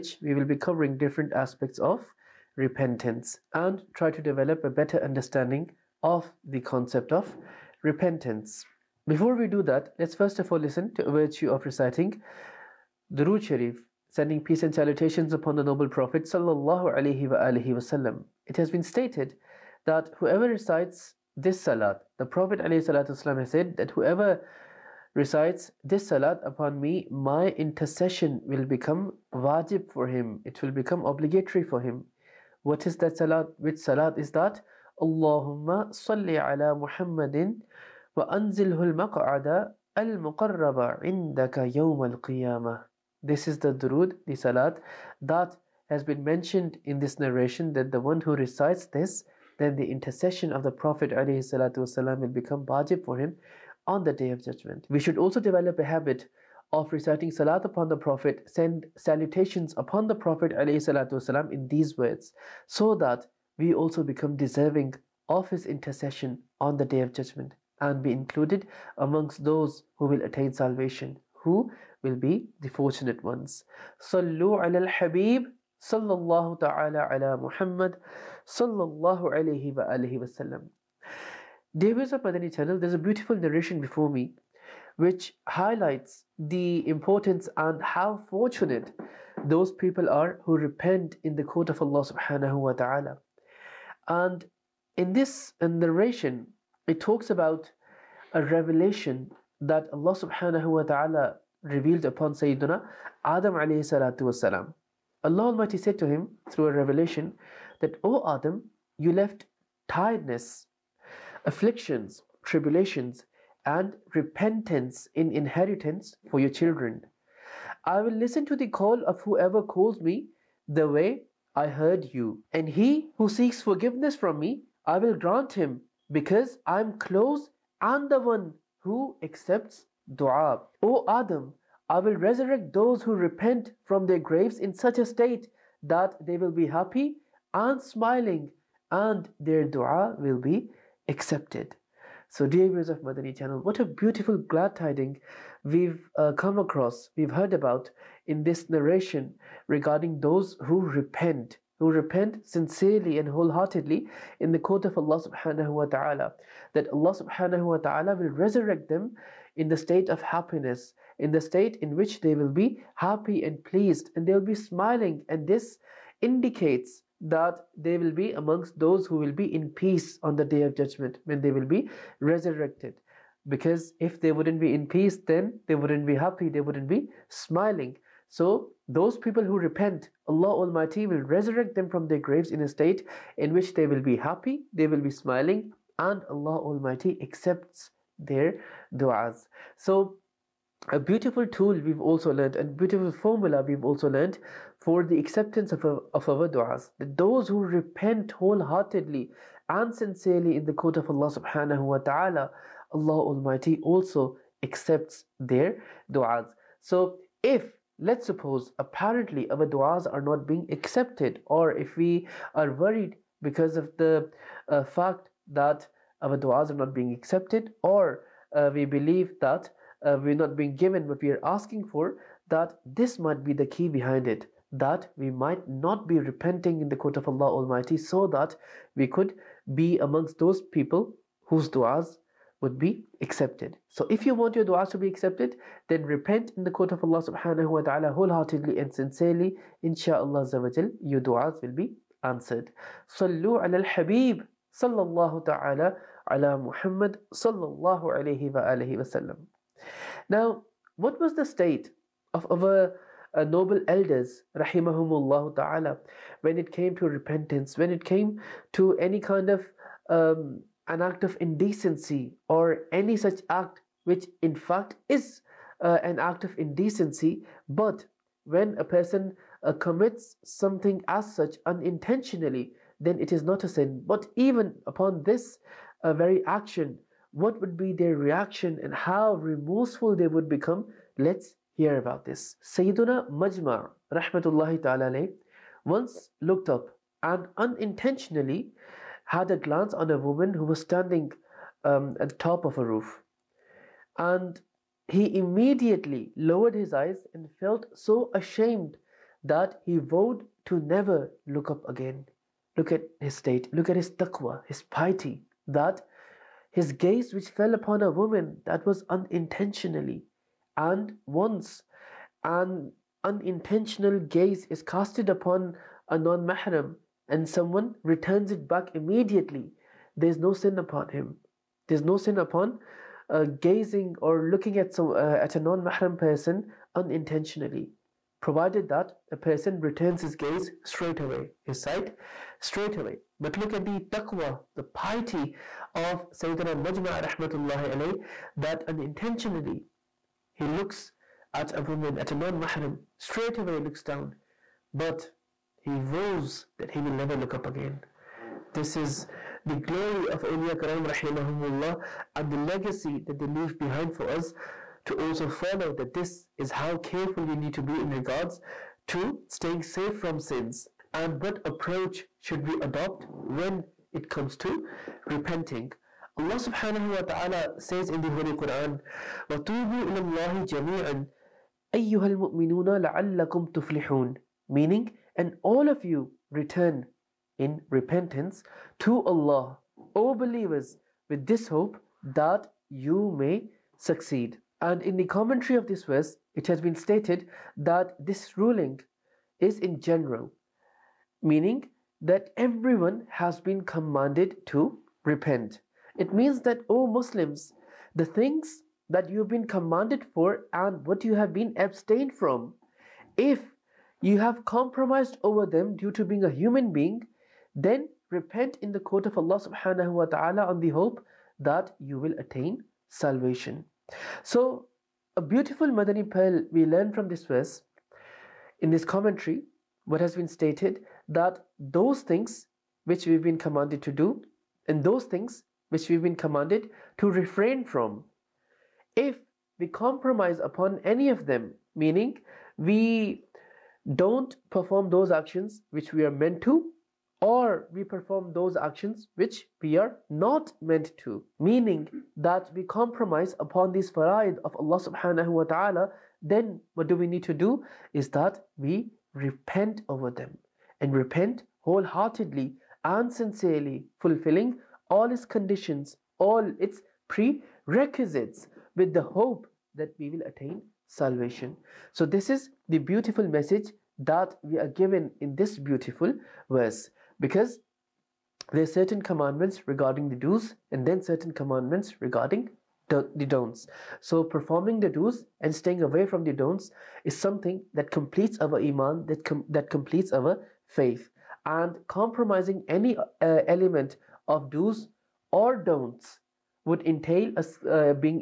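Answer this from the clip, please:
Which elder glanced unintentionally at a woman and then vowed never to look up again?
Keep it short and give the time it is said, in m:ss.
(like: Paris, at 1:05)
Sayyiduna Majmar, at 4:42.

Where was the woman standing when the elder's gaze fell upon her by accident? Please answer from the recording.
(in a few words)
at the top of a roof.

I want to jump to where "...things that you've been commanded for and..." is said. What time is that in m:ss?
6:38.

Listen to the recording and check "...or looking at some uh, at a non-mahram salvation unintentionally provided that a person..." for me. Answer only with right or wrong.
wrong.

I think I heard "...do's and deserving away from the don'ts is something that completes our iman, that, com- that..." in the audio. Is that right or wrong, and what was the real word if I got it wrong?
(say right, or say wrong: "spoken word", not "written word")
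wrong: "staying", not "deserving".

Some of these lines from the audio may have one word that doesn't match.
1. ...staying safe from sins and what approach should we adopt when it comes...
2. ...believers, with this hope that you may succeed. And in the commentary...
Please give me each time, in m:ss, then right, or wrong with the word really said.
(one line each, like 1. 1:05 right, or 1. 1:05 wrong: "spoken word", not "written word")
1. 5:59 right
2. 6:20 right.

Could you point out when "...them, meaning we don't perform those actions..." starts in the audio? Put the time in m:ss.
7:11.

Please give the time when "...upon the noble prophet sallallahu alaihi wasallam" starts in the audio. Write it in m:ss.
0:15.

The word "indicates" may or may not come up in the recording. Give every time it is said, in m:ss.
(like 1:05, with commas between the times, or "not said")
2:46.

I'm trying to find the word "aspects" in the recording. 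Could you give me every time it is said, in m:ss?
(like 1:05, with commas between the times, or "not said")
0:01.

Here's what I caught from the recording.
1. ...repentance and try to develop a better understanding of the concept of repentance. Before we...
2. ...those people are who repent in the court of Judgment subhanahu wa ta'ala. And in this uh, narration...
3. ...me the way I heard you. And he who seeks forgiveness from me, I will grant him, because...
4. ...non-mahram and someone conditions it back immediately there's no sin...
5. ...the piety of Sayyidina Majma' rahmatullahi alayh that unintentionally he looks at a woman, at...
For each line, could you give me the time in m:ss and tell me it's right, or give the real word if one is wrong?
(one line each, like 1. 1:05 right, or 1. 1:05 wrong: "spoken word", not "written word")
1. 0:02 right
2. 1:29 wrong: "Allah", not "Judgment"
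3. 1:59 right
4. 5:16 wrong: "returns", not "conditions"
5. 5:34 right.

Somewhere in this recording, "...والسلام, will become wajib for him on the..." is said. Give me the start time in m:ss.
0:51.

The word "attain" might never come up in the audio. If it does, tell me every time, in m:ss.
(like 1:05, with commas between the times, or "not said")
1:10, 6:52, 7:40.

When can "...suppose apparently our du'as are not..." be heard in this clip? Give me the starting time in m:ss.
3:28.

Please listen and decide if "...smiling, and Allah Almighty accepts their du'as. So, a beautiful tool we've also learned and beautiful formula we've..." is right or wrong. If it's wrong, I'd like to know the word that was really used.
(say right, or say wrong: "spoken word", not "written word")
right.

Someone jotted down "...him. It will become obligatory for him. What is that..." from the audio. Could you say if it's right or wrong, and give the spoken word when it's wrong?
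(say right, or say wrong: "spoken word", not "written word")
right.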